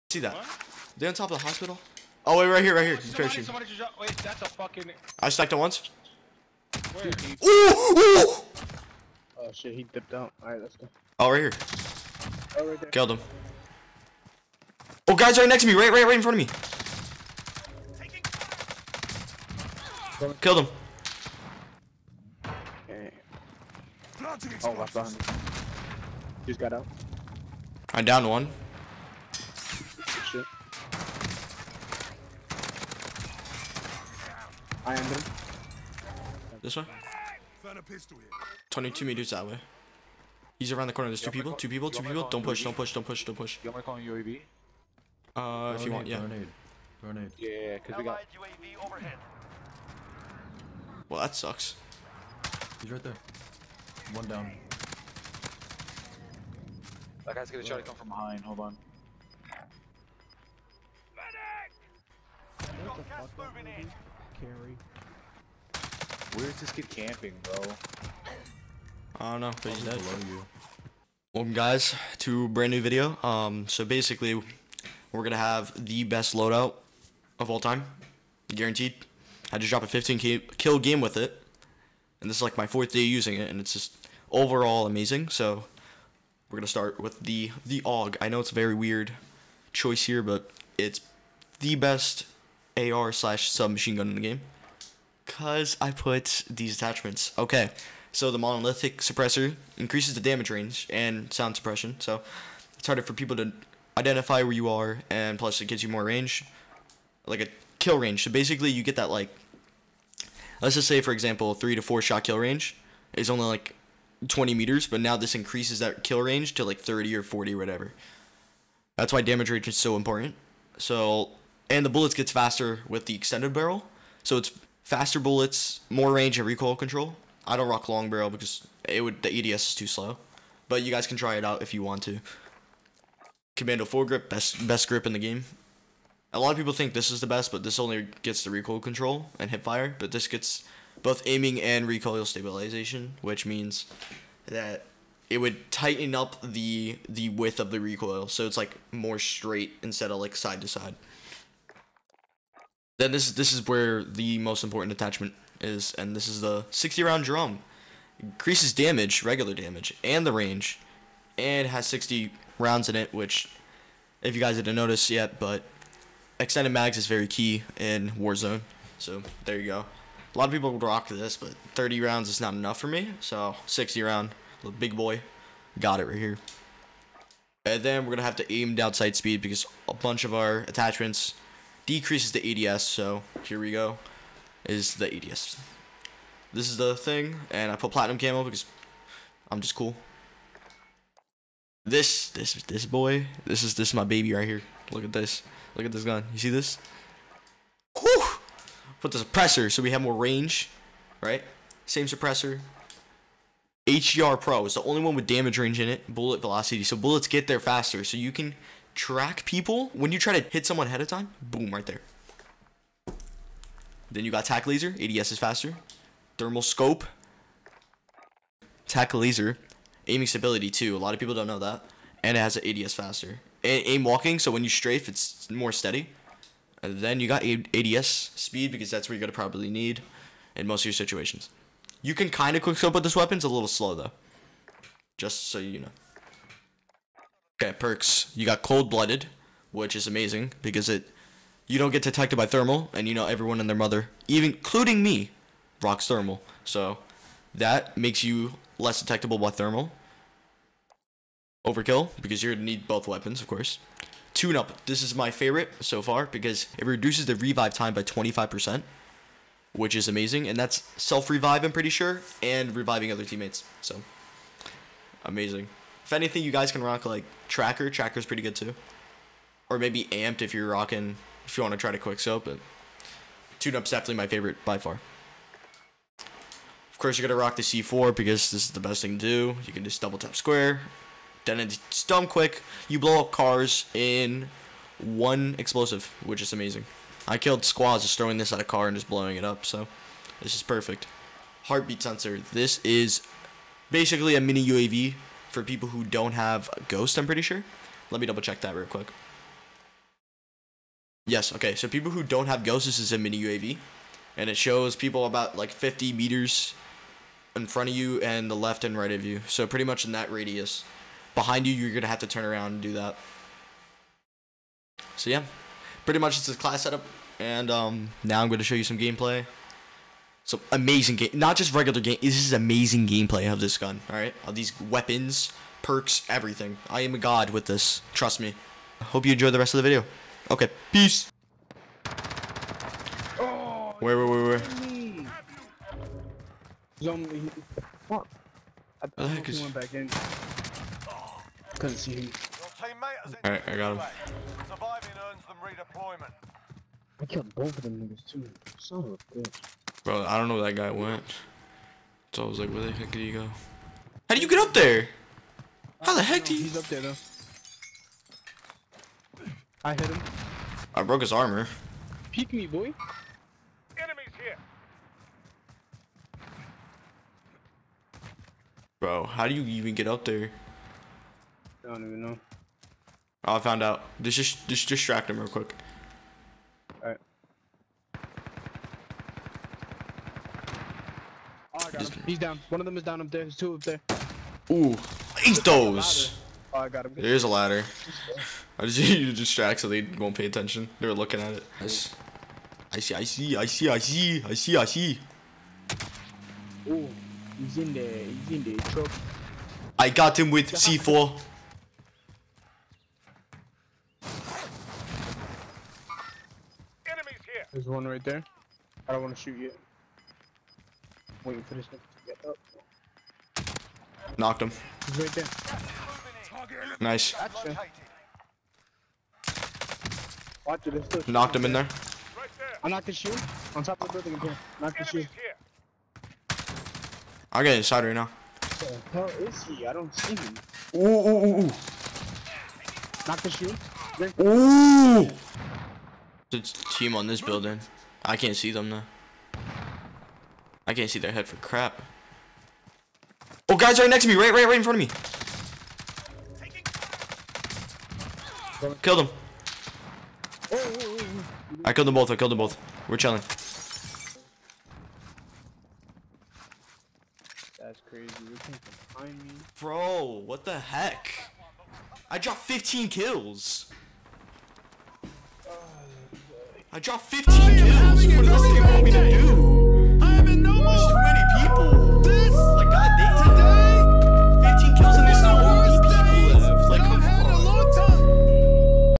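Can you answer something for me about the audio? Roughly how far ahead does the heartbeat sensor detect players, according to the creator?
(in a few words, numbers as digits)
50 meters.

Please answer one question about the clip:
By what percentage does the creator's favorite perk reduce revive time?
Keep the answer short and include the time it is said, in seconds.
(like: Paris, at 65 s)
25%, at 258 s.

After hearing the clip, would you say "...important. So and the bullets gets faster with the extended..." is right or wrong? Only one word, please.
right.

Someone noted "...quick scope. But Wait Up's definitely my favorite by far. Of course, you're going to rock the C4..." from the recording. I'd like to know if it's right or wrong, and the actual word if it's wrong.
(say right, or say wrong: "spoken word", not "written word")
wrong: "Tune", not "Wait".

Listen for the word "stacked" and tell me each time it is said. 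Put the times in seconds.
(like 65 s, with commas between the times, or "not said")
5 s.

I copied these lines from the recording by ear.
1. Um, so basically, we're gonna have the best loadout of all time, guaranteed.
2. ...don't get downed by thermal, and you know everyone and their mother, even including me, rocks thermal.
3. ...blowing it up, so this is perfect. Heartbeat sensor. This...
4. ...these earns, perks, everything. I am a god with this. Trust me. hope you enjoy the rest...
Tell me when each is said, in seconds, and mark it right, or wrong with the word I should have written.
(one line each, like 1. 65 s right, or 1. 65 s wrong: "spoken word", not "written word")
1. 73 s right
2. 241 s wrong: "detected", not "downed"
3. 289 s right
4. 324 s wrong: "weapons", not "earns".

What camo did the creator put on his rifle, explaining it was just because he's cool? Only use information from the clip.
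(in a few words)
platinum.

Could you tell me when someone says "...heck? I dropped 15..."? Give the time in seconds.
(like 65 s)
460 s.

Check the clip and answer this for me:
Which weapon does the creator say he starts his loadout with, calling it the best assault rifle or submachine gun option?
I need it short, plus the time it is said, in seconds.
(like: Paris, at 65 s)
AUG, at 87 s.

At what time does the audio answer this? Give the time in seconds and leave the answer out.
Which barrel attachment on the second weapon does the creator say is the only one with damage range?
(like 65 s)
203 s.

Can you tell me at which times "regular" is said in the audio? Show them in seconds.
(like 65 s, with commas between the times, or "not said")
159 s, 321 s.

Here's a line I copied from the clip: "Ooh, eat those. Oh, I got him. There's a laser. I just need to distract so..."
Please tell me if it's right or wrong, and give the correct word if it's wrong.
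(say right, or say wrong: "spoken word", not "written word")
wrong: "ladder", not "laser".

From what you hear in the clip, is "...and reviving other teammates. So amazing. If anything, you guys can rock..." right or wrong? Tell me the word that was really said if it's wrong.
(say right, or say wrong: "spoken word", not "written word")
right.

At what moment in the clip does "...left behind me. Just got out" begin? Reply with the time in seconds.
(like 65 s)
24 s.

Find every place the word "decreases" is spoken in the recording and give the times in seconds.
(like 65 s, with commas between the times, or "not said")
181 s.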